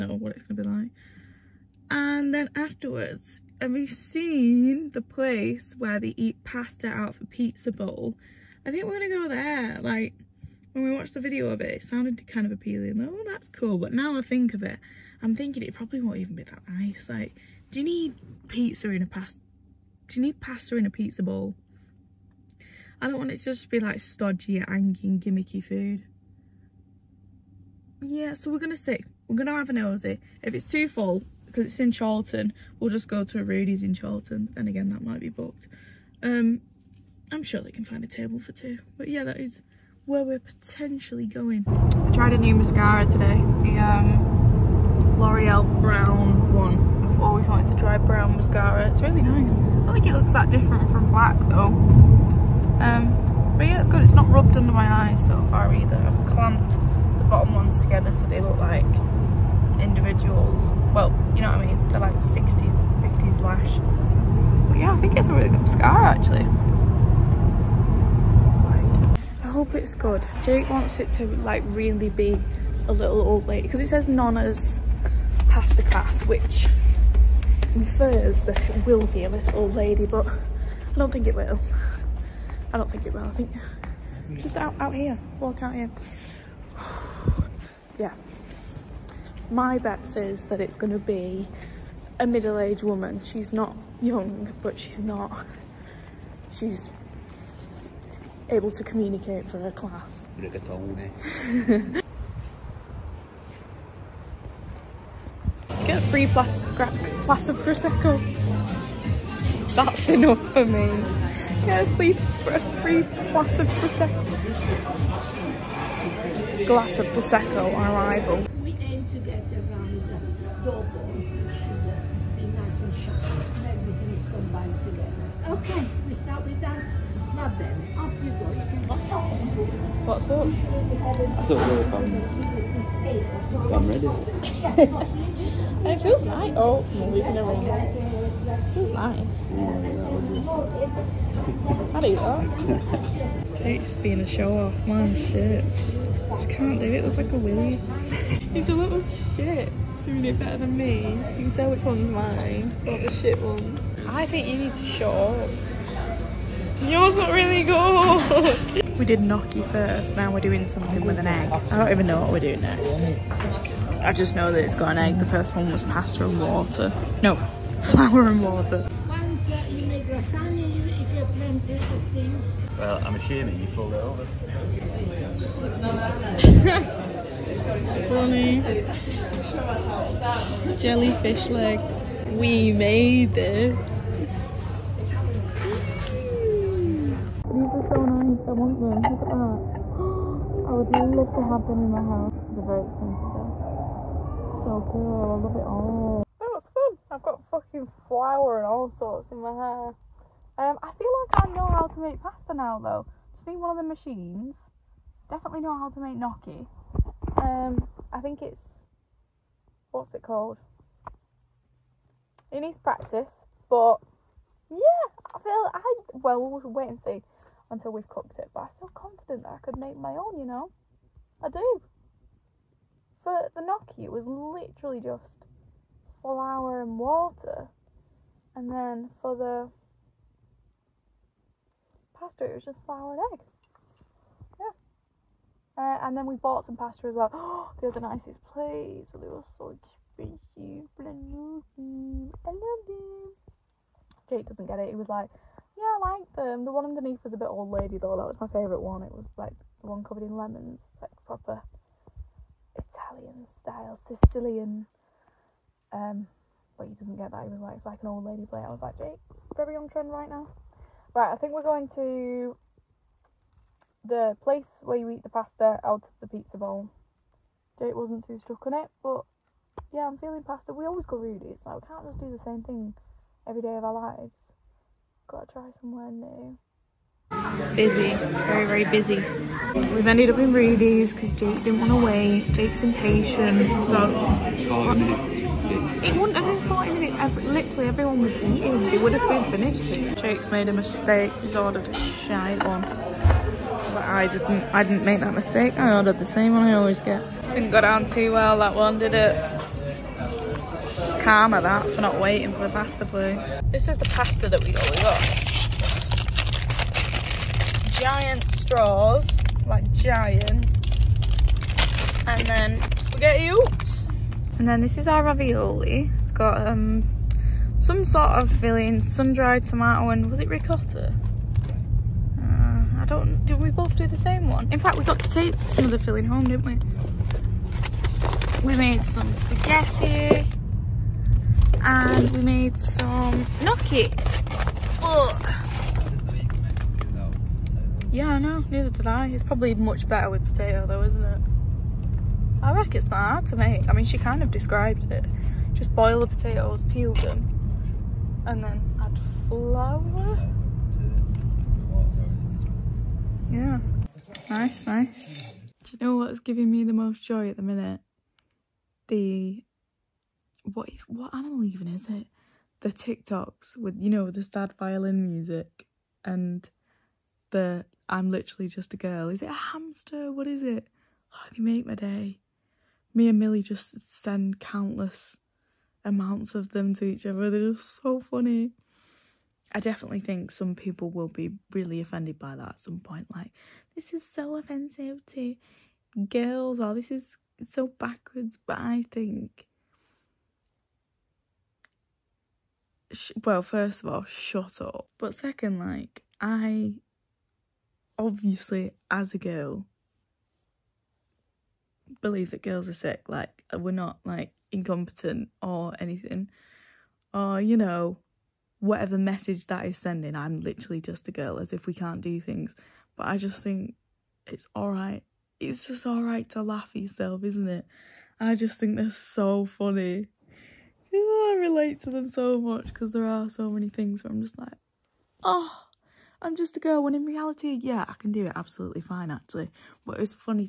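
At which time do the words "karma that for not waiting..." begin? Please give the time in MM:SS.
05:01.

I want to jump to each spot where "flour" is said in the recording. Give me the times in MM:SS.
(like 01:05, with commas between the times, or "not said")
02:47, 03:18, 03:46, 03:52, 05:49.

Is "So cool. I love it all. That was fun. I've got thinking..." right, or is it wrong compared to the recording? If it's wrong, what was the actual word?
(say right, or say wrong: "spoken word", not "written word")
wrong: "fucking", not "thinking".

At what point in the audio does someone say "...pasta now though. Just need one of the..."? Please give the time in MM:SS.
03:22.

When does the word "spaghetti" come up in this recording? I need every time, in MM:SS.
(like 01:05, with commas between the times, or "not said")
05:13, 05:29.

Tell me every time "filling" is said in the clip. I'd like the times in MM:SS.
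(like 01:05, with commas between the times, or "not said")
05:18, 05:25.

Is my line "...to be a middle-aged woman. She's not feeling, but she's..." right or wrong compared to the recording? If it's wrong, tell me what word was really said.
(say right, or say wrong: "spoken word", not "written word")
wrong: "young", not "feeling".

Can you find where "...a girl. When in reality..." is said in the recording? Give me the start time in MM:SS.
07:06.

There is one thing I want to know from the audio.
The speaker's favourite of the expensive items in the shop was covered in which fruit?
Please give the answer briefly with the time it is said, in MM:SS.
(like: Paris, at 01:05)
Lemons, at 04:09.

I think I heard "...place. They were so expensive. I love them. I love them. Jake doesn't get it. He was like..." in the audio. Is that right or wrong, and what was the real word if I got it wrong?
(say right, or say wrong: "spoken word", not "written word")
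right.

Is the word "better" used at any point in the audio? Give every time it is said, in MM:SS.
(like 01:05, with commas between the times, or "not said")
02:30, 05:40.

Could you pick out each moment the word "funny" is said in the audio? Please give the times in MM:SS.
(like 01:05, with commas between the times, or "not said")
03:00, 06:18, 06:59.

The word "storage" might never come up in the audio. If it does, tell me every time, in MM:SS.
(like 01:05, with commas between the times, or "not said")
not said.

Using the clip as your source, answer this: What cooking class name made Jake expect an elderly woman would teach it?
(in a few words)
Nonna's pasta class.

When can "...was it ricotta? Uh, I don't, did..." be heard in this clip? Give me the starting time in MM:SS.
05:20.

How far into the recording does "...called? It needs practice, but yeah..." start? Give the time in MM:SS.
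03:30.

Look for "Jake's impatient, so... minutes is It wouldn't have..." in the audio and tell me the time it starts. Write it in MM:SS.
04:42.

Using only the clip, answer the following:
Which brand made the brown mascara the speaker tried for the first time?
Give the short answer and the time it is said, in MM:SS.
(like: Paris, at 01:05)
L'Oreal, at 00:43.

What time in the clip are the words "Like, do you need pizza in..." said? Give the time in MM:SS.
00:17.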